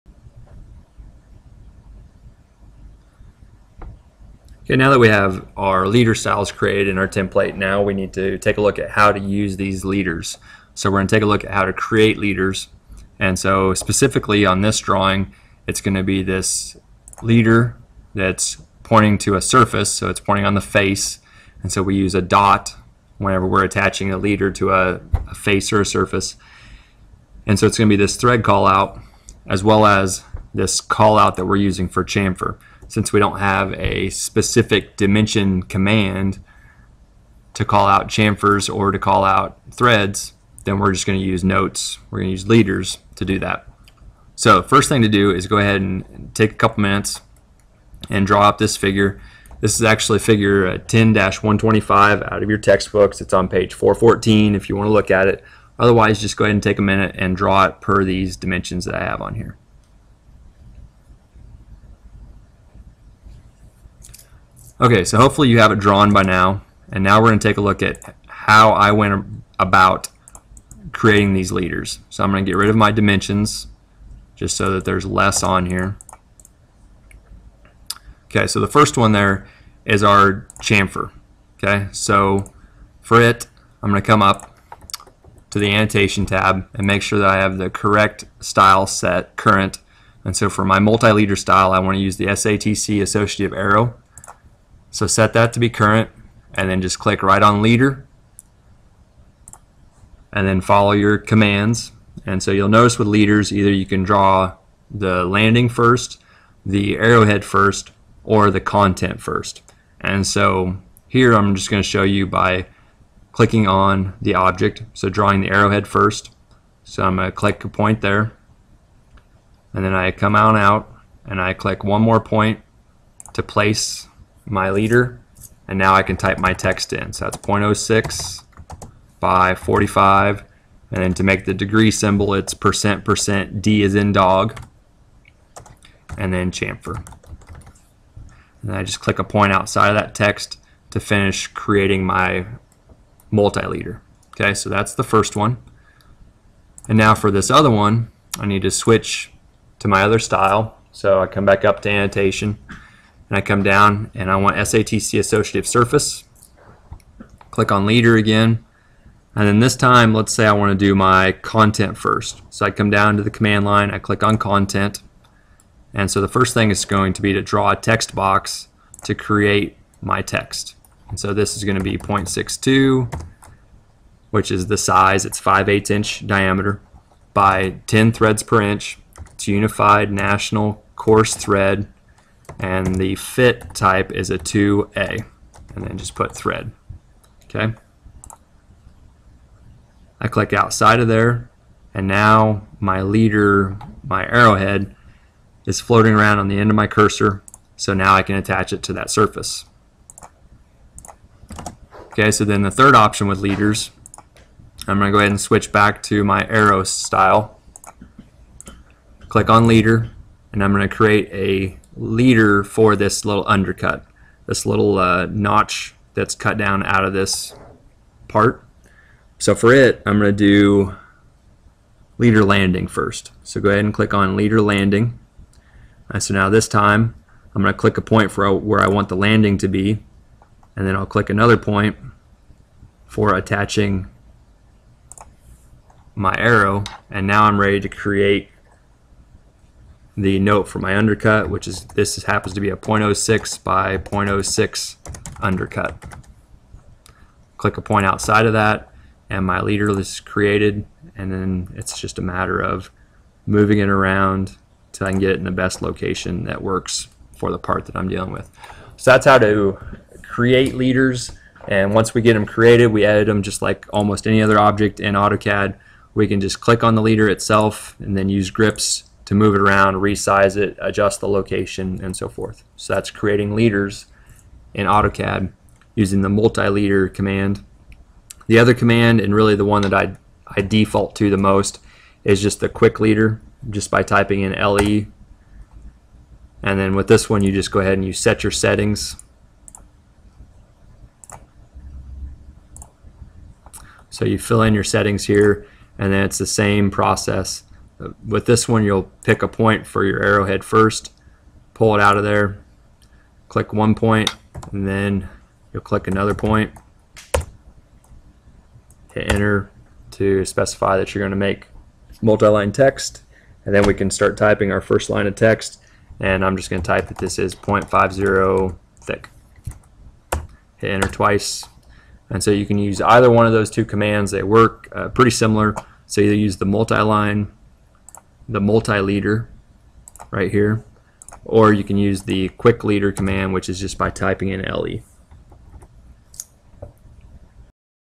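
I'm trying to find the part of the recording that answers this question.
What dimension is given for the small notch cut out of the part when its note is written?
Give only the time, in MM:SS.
04:02.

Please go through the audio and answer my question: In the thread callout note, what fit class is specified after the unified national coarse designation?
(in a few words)
2A.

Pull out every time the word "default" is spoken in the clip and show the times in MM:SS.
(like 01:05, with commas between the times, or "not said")
04:40.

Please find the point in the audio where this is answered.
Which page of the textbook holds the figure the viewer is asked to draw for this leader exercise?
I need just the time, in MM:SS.
00:53.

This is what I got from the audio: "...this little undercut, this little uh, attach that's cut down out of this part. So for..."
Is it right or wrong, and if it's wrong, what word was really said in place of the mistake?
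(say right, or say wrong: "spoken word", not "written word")
wrong: "notch", not "attach".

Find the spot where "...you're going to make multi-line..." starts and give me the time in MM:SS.
05:11.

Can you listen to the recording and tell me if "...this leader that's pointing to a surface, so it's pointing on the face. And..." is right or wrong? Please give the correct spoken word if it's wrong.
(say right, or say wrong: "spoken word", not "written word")
right.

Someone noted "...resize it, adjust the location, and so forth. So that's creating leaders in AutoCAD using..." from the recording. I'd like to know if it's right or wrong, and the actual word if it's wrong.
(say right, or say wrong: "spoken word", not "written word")
right.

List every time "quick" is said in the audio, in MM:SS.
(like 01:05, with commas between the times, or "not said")
04:42, 05:32.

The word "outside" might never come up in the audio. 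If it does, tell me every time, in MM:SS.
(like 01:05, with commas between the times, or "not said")
02:19, 03:10, 04:08.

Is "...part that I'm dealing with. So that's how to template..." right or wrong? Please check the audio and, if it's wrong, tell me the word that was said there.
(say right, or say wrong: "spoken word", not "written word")
wrong: "create", not "template".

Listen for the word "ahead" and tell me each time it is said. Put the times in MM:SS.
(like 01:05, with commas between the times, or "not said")
00:45, 00:56, 03:25, 03:43, 04:47.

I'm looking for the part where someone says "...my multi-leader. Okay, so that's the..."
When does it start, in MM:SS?
02:22.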